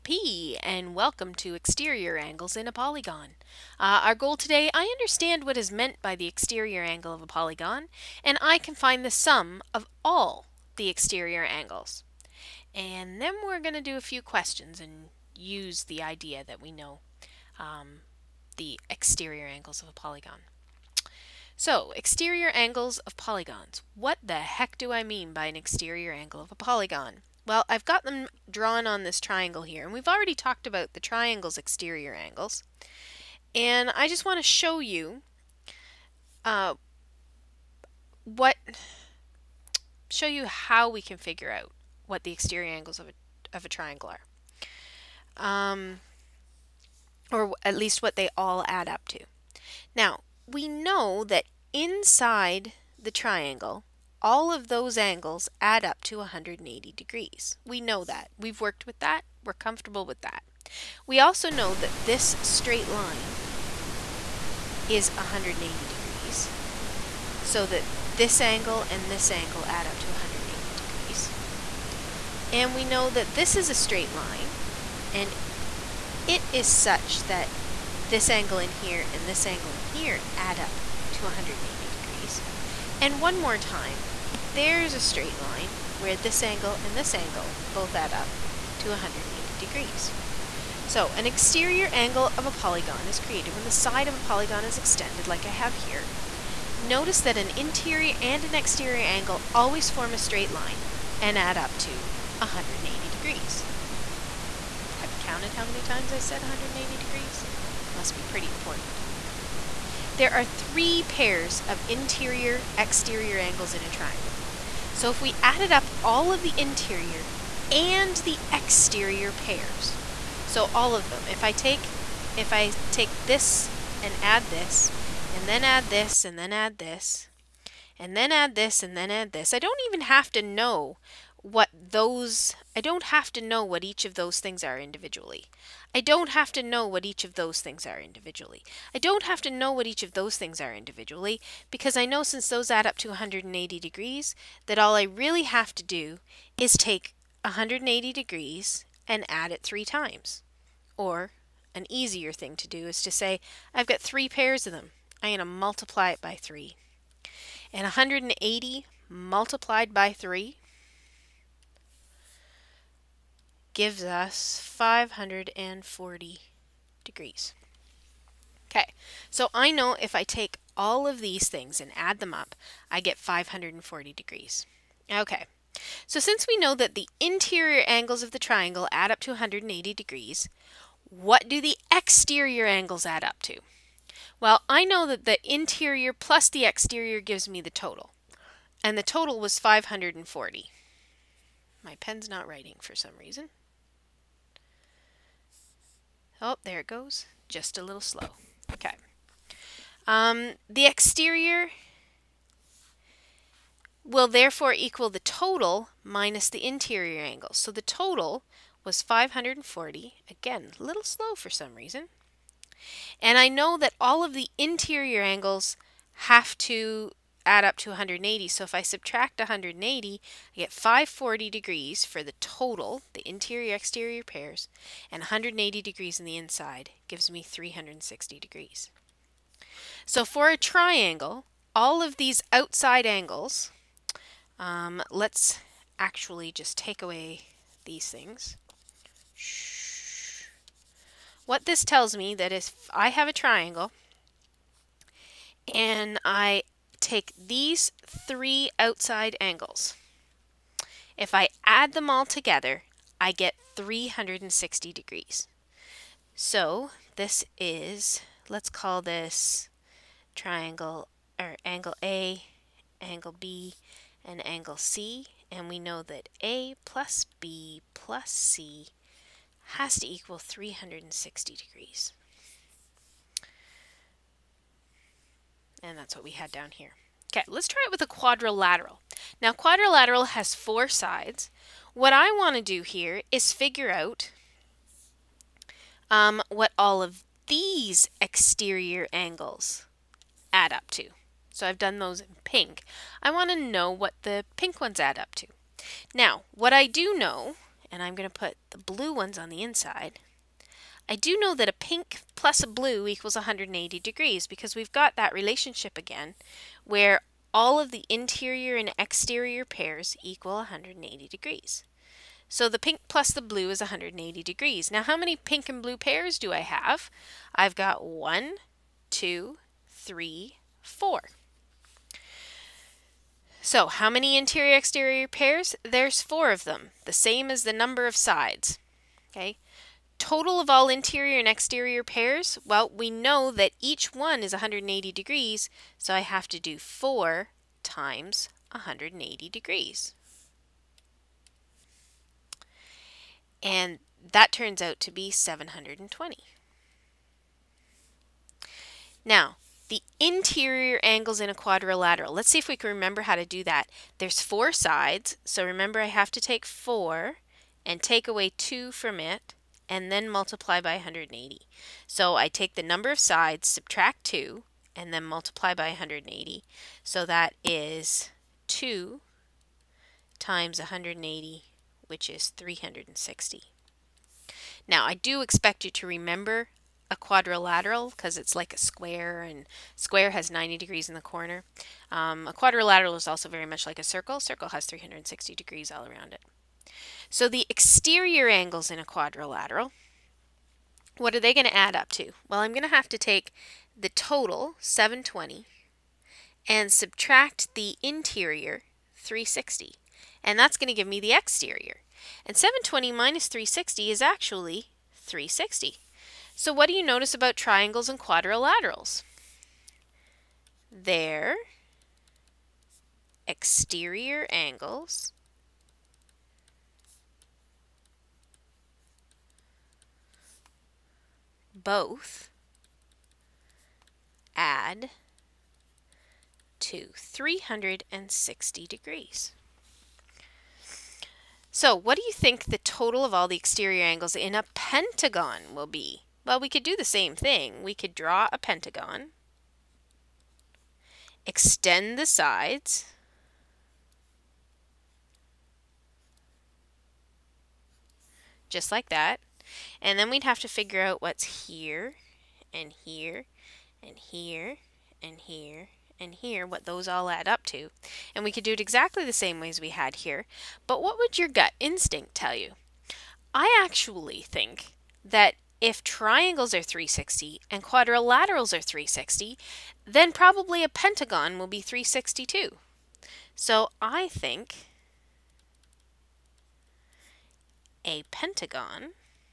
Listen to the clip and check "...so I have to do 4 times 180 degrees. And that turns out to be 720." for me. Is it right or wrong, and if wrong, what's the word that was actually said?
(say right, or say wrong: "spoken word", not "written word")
right.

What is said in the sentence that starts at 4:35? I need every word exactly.
And that's what we had down here.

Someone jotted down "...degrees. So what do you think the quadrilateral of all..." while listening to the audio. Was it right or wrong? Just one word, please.
wrong.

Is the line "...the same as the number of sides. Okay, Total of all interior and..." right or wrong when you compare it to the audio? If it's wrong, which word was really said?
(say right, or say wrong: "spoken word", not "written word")
right.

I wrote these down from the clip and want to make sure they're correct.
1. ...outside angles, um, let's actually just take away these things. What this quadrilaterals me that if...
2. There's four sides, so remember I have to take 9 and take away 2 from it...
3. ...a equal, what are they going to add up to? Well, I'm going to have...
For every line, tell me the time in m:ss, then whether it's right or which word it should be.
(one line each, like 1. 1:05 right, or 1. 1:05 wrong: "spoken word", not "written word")
1. 3:52 wrong: "tells", not "quadrilaterals"
2. 5:54 wrong: "4", not "9"
3. 6:28 wrong: "quadrilateral", not "equal".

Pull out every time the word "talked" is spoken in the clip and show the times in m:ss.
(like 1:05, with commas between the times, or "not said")
0:30.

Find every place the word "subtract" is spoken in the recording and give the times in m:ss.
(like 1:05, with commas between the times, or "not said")
3:38, 6:03, 6:36.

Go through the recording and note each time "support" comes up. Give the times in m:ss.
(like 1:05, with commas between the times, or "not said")
not said.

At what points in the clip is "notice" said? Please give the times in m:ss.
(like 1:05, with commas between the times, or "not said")
1:36, 6:47.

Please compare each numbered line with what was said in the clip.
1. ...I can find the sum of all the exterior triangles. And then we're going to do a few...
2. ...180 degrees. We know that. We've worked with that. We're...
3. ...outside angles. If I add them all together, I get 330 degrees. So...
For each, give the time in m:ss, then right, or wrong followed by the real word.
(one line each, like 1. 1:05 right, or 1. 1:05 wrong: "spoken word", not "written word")
1. 0:08 wrong: "angles", not "triangles"
2. 0:56 right
3. 4:08 wrong: "360", not "330".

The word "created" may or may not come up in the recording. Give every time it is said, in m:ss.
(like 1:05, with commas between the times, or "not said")
1:33.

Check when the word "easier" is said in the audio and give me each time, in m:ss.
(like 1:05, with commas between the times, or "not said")
2:31.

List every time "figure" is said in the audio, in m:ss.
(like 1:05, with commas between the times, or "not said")
0:41, 4:43, 7:30.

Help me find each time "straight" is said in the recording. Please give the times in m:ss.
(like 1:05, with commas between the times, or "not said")
1:02, 1:13, 1:24, 1:40.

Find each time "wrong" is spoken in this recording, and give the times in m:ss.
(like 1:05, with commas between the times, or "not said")
not said.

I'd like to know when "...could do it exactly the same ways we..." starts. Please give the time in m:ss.
7:38.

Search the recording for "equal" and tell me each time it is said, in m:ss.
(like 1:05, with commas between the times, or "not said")
3:24, 4:30, 5:03, 5:10.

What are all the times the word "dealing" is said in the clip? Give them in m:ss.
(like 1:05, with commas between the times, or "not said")
not said.